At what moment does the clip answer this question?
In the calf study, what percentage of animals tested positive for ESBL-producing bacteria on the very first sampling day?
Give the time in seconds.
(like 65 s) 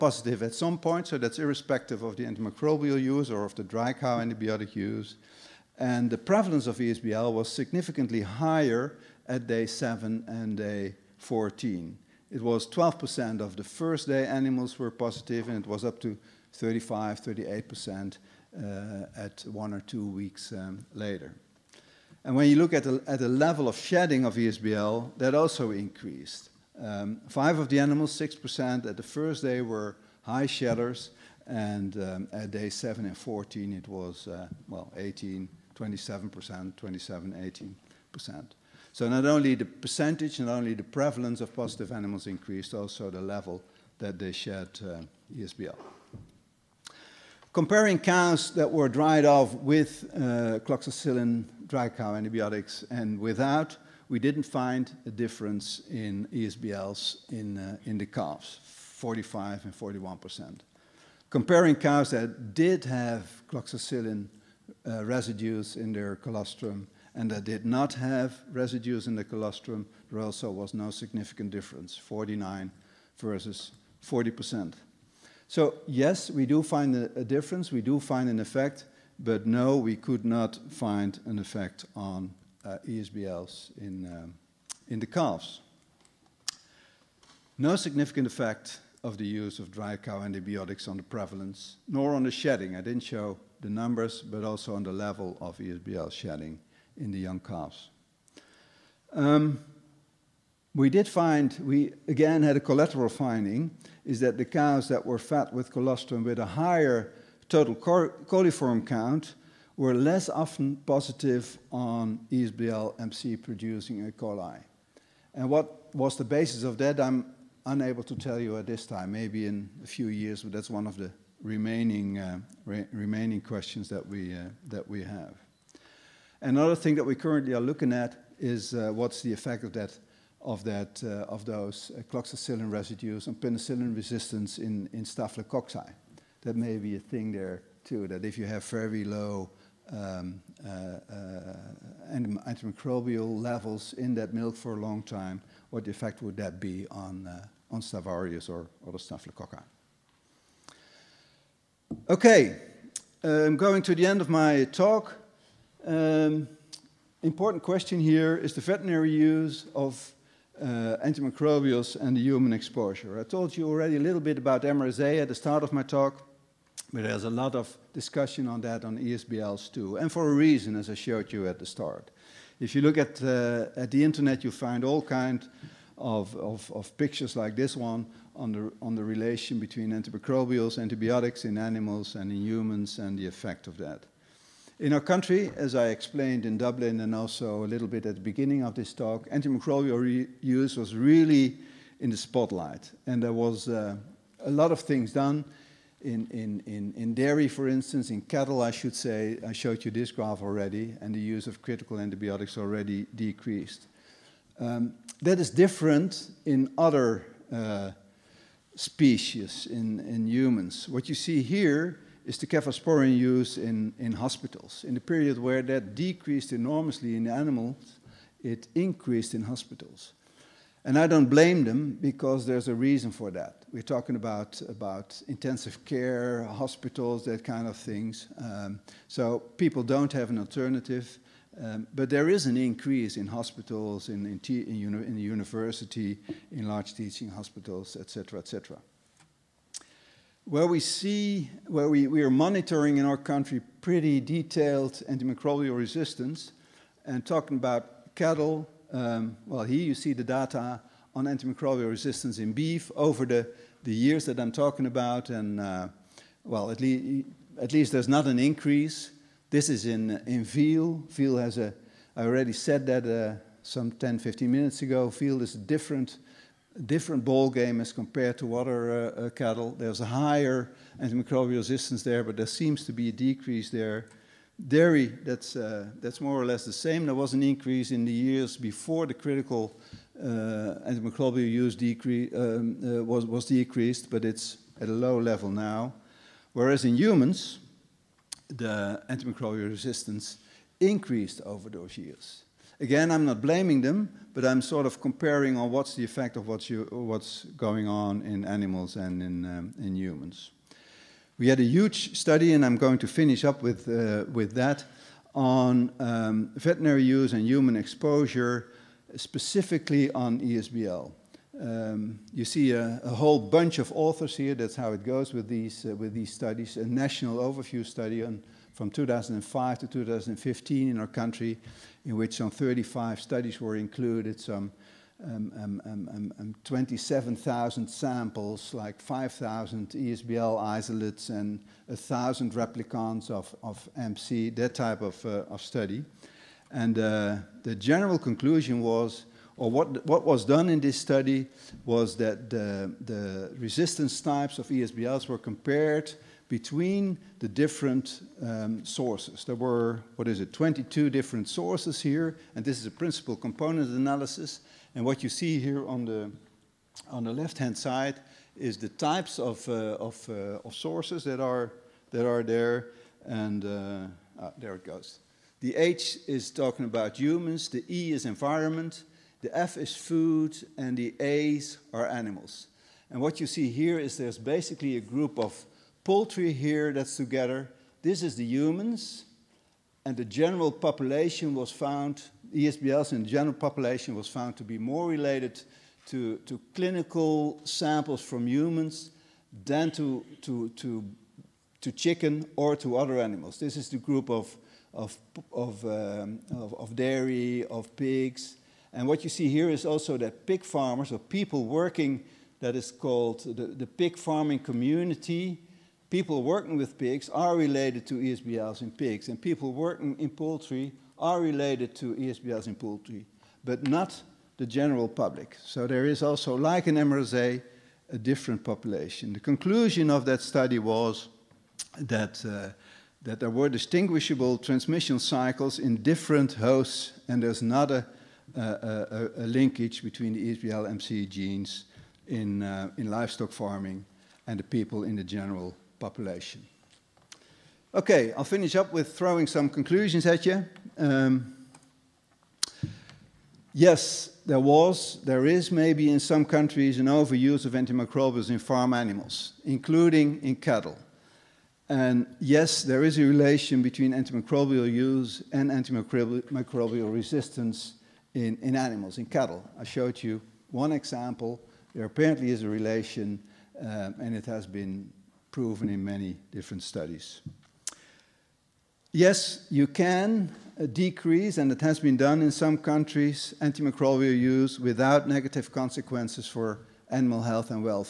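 12 s.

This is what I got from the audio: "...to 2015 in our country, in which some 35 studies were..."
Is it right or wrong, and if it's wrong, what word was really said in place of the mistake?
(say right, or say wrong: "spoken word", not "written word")
right.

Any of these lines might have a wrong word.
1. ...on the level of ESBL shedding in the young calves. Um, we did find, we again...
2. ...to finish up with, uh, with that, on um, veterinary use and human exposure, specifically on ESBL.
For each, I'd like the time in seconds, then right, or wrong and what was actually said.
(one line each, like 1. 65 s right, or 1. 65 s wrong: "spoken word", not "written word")
1. 94 s right
2. 302 s right.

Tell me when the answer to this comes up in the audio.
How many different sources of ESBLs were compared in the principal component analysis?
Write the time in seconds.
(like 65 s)
350 s.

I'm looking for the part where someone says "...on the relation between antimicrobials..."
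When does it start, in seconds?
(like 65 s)
178 s.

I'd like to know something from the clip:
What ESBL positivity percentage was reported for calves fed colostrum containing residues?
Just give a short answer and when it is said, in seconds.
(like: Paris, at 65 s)
49%, at 71 s.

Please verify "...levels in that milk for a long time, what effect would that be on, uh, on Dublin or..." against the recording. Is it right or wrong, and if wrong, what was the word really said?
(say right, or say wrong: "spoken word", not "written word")
wrong: "Staphylococcus", not "Dublin".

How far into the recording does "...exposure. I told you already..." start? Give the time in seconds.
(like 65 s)
162 s.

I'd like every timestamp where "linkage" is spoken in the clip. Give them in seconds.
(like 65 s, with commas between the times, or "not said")
429 s.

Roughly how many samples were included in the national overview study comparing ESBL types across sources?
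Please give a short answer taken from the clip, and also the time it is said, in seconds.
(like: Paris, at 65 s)
27,000, at 326 s.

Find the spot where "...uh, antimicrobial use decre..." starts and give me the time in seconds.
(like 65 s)
280 s.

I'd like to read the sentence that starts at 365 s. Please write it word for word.
The H is talking about humans, the E is environment, the F is food, and the A's are animals.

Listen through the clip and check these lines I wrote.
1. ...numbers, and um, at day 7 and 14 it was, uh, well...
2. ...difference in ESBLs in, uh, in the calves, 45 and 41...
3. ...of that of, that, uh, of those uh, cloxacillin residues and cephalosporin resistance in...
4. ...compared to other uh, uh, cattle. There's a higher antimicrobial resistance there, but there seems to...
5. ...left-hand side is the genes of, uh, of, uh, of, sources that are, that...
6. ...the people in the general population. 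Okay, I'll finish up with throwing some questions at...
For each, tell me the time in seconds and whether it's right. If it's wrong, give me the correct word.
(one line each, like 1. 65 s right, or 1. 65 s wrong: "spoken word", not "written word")
1. 30 s wrong: "shedders", not "numbers"
2. 55 s right
3. 129 s wrong: "penicillin", not "cephalosporin"
4. 267 s right
5. 357 s wrong: "types", not "genes"
6. 434 s wrong: "conclusions", not "questions".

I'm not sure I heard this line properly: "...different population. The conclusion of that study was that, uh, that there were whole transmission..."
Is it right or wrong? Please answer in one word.
wrong.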